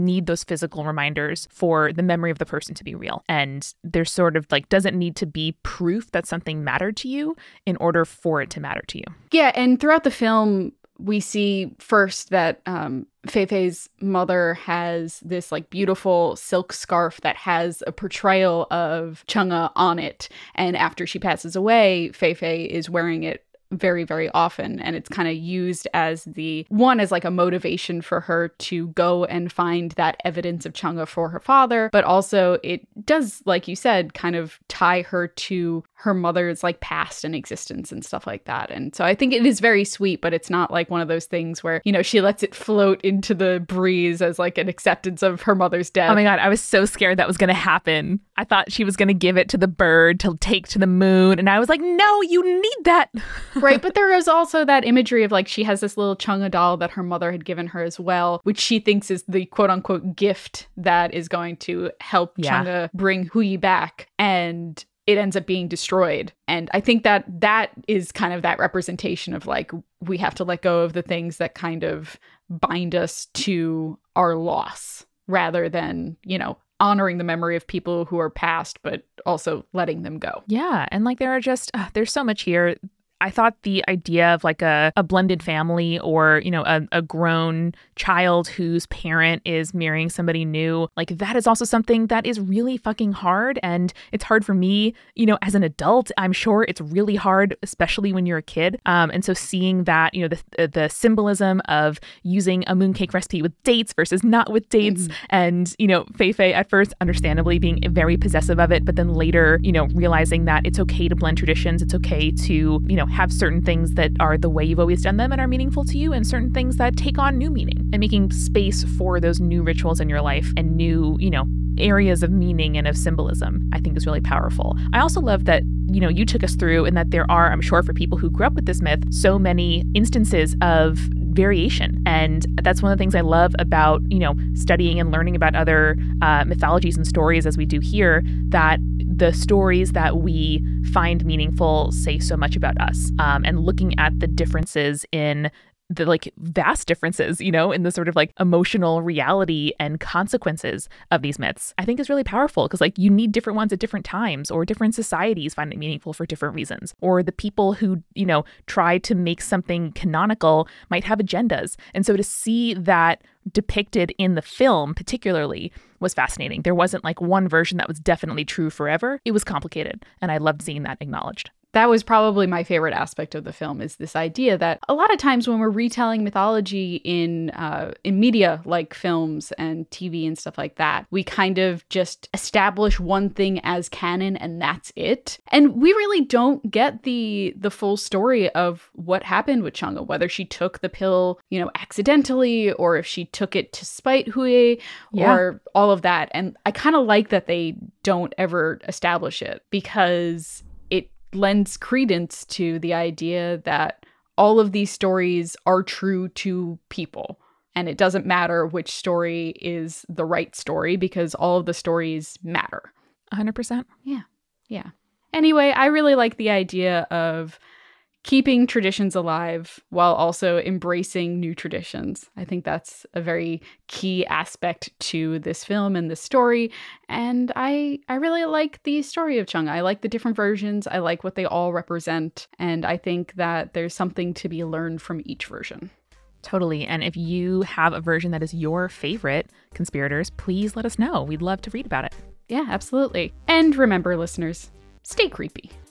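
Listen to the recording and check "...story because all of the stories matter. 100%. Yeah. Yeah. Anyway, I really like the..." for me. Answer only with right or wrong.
right.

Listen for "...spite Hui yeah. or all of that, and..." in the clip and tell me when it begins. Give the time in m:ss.
3:13.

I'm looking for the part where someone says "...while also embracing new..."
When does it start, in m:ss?
3:39.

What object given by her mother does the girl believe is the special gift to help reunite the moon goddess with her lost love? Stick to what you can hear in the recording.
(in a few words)
Chang'e doll.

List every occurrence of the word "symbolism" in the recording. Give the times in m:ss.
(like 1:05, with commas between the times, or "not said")
1:40, 2:02.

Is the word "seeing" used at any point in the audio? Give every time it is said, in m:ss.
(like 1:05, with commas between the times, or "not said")
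1:39, 2:50.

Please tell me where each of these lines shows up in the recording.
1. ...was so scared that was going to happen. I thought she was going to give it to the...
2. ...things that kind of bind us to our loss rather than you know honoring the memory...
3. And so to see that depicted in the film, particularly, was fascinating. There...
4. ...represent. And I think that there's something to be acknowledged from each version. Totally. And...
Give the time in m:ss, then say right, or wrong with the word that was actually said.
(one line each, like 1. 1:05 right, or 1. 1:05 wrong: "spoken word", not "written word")
1. 0:46 right
2. 1:11 right
3. 2:41 right
4. 3:51 wrong: "learned", not "acknowledged".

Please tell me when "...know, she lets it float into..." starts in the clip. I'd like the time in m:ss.
0:41.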